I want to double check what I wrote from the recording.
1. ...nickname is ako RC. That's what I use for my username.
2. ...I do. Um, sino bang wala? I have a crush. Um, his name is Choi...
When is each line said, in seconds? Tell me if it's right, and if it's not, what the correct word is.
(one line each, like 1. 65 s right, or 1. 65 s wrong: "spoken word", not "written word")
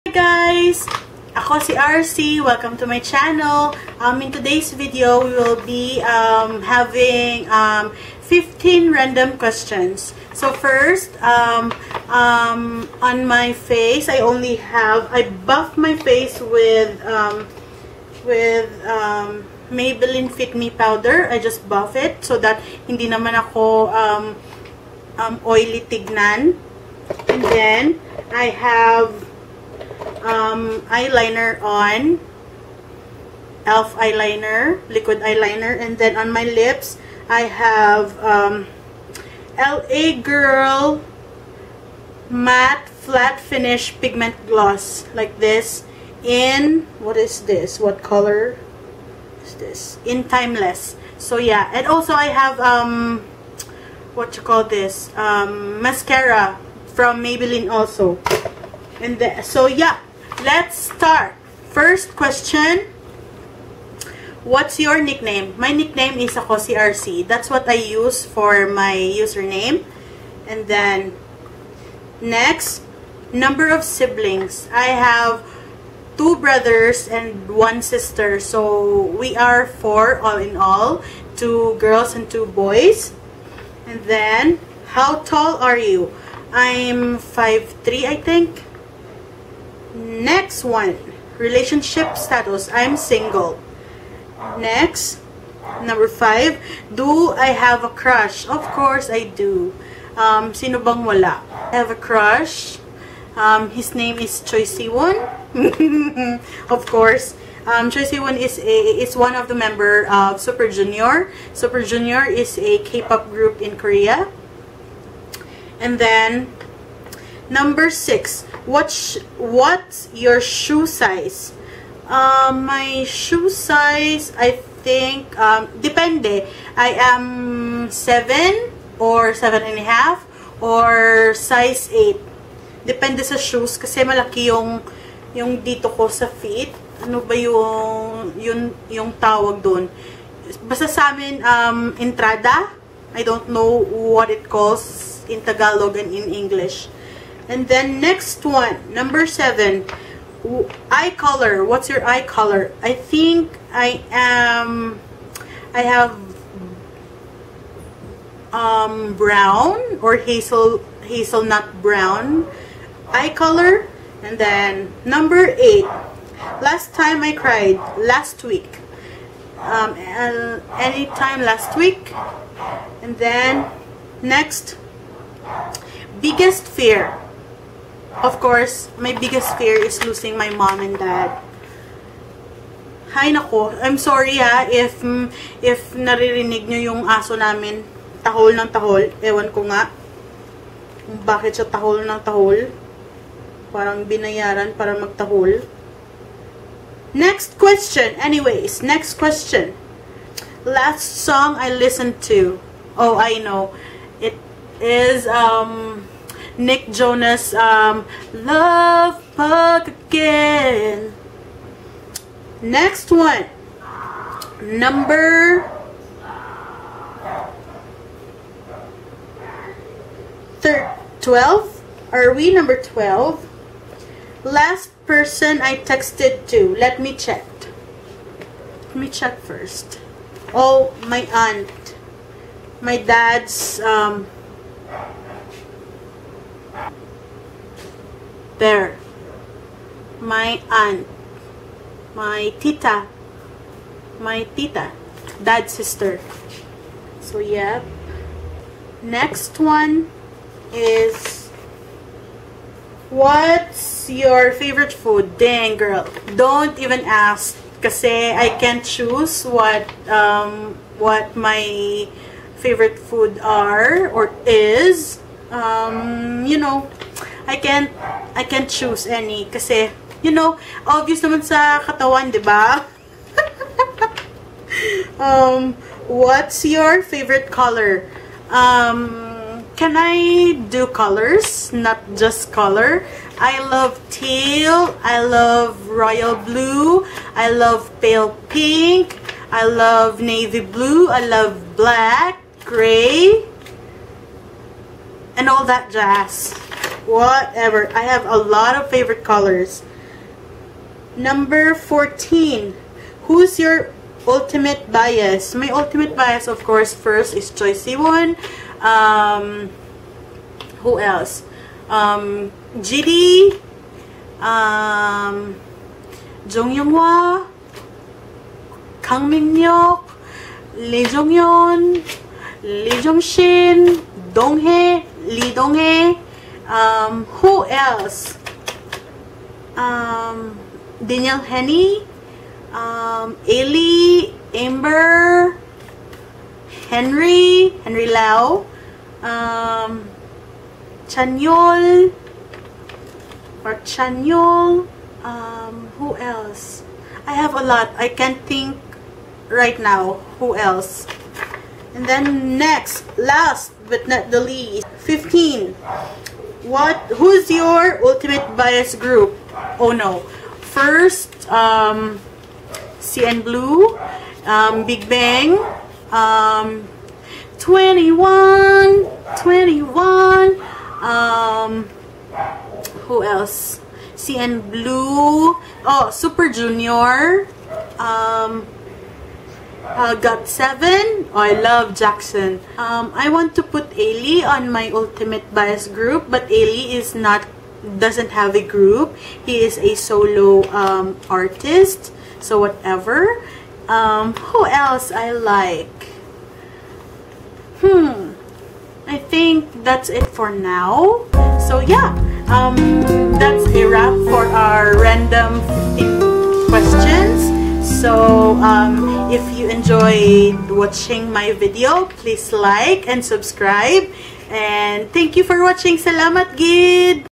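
1. 65 s right
2. 99 s right.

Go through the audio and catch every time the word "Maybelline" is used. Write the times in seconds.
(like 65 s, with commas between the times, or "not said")
19 s, 57 s.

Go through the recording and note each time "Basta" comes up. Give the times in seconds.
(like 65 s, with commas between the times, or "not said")
140 s.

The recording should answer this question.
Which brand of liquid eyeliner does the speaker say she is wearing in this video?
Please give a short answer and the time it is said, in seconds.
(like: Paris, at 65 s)
e.l.f., at 33 s.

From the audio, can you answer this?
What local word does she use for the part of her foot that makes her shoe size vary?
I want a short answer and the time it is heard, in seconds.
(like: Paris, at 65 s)
entrada, at 141 s.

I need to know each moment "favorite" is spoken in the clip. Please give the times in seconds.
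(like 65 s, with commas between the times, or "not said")
254 s, 262 s, 277 s, 298 s.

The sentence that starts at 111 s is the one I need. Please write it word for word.
Super Junior is a K-pop group in Korea.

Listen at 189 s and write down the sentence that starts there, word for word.
Ewan ko nga bakit siya tahol ng tahol.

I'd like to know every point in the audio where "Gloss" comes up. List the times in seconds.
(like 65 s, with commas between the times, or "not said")
44 s.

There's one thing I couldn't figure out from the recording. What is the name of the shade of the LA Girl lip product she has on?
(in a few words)
Timeless.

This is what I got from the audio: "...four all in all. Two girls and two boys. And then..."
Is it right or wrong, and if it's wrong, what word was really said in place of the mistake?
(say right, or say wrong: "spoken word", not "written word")
right.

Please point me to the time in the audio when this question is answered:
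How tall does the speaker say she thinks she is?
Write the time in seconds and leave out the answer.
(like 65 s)
87 s.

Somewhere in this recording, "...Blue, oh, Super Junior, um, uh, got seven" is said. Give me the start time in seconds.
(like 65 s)
374 s.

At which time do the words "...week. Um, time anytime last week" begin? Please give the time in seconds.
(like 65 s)
168 s.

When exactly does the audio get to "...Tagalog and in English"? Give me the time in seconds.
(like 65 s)
145 s.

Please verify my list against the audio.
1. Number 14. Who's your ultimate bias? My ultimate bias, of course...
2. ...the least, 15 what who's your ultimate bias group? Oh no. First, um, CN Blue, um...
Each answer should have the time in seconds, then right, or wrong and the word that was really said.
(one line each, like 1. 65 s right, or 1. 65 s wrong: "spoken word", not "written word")
1. 301 s right
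2. 354 s right.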